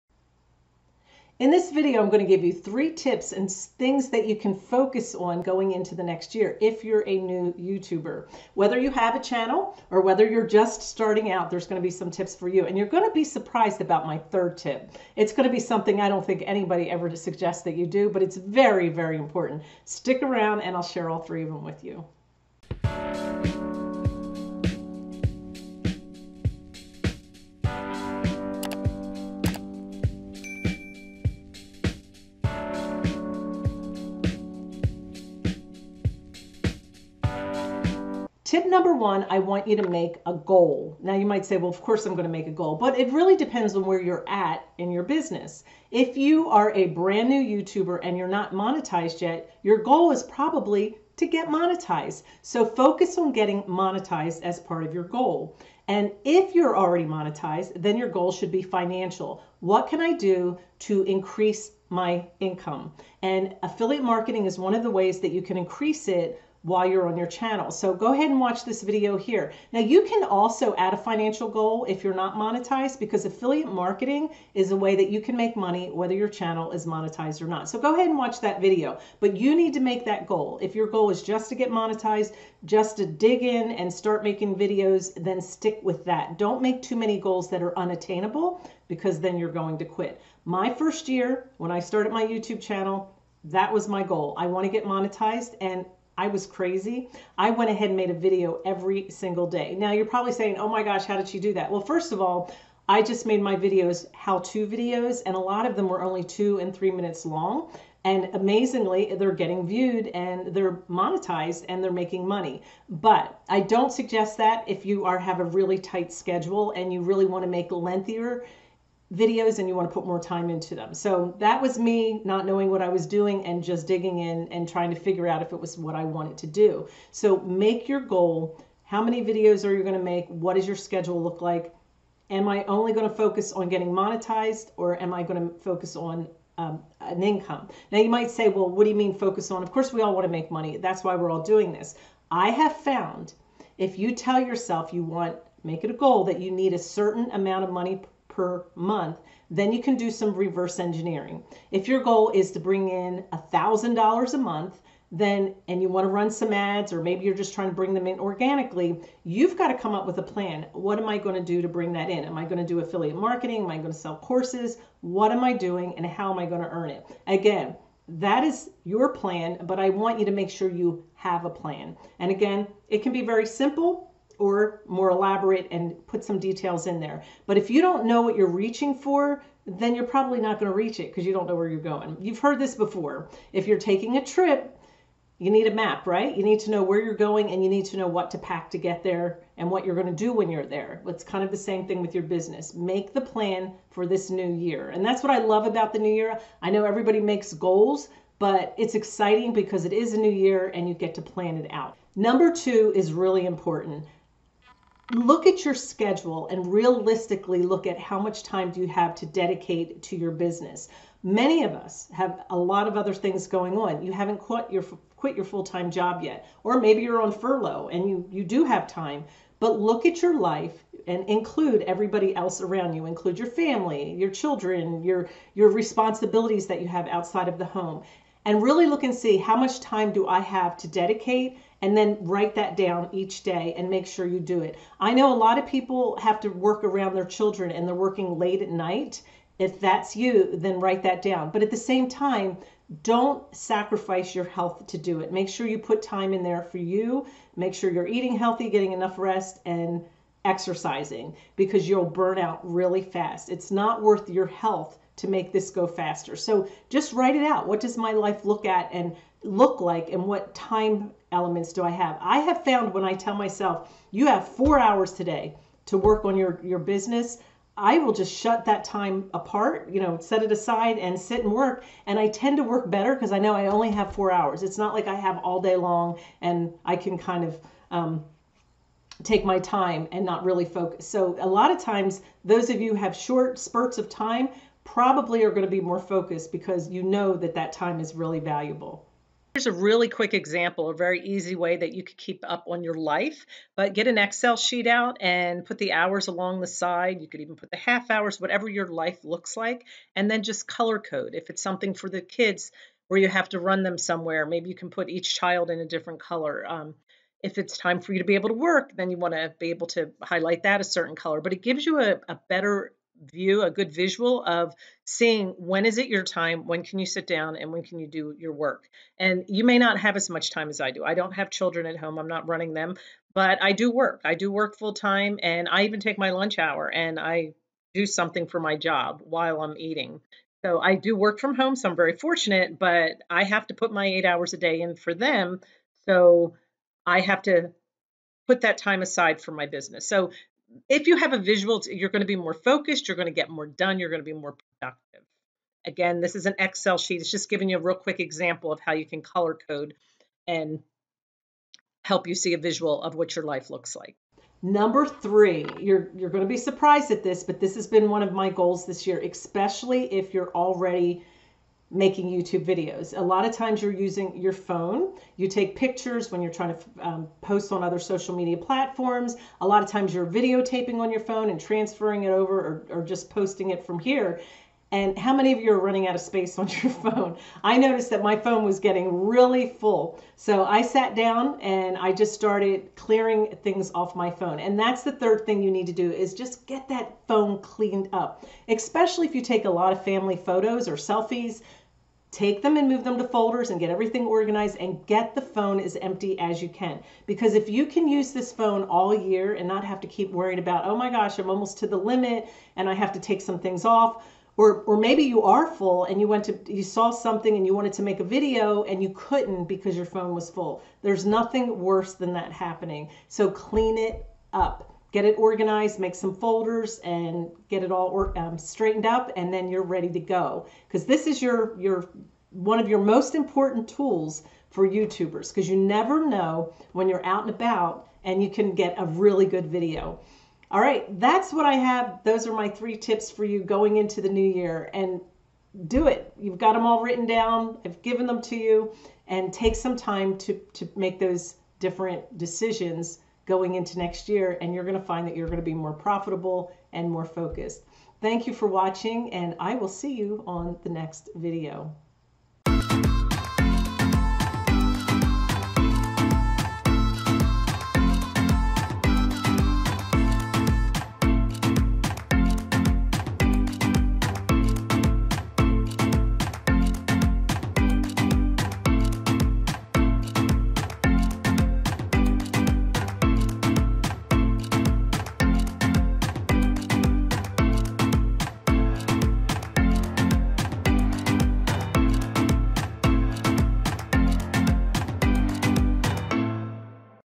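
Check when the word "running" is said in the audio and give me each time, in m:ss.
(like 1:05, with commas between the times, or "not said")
5:22, 6:15.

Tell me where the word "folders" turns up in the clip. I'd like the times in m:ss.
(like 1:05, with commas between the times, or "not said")
6:33, 6:56.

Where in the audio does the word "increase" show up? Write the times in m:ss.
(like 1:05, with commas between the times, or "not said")
1:01, 1:05.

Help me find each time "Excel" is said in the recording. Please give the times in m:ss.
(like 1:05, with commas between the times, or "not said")
4:54, 5:46.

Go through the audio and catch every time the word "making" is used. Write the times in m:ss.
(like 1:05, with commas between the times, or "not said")
1:24, 1:52, 6:01.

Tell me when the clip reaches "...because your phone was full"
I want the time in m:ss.
6:49.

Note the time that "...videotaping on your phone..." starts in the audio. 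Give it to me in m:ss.
6:10.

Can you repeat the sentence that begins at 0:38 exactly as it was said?
Tip number one, I want you to make a goal.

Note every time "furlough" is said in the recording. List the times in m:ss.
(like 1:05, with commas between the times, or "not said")
3:37.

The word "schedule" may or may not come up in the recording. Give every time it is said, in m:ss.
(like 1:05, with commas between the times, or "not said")
1:56, 2:10, 3:25.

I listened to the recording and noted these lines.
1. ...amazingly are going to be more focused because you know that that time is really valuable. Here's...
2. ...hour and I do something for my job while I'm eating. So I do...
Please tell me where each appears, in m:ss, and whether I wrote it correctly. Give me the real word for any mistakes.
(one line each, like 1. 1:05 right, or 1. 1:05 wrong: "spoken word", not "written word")
1. 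4:44 wrong: "probably", not "amazingly"
2. 5:26 right.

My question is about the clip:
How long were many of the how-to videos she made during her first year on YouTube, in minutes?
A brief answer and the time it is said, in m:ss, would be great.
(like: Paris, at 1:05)
2 and 3 minutes, at 1:46.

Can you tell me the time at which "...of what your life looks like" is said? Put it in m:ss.
5:53.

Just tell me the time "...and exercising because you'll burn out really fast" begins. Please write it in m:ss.
4:09.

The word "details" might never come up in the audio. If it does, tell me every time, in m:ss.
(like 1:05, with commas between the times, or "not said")
2:56.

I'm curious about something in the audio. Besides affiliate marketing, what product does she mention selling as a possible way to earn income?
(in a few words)
courses.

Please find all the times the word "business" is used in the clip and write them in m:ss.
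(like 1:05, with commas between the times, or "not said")
0:45, 3:12, 3:30, 4:26, 5:39.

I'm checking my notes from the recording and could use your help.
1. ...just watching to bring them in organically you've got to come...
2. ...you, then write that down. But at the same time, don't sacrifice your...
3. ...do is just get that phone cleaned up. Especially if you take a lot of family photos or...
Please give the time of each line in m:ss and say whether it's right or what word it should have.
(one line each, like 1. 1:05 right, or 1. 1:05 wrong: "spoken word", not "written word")
1. 2:37 wrong: "trying", not "watching"
2. 4:00 right
3. 6:25 right.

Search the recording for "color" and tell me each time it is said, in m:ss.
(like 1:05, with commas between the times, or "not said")
5:00, 5:06, 5:11, 5:49.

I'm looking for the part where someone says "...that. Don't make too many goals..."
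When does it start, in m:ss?
1:26.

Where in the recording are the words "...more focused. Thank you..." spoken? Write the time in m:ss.
7:27.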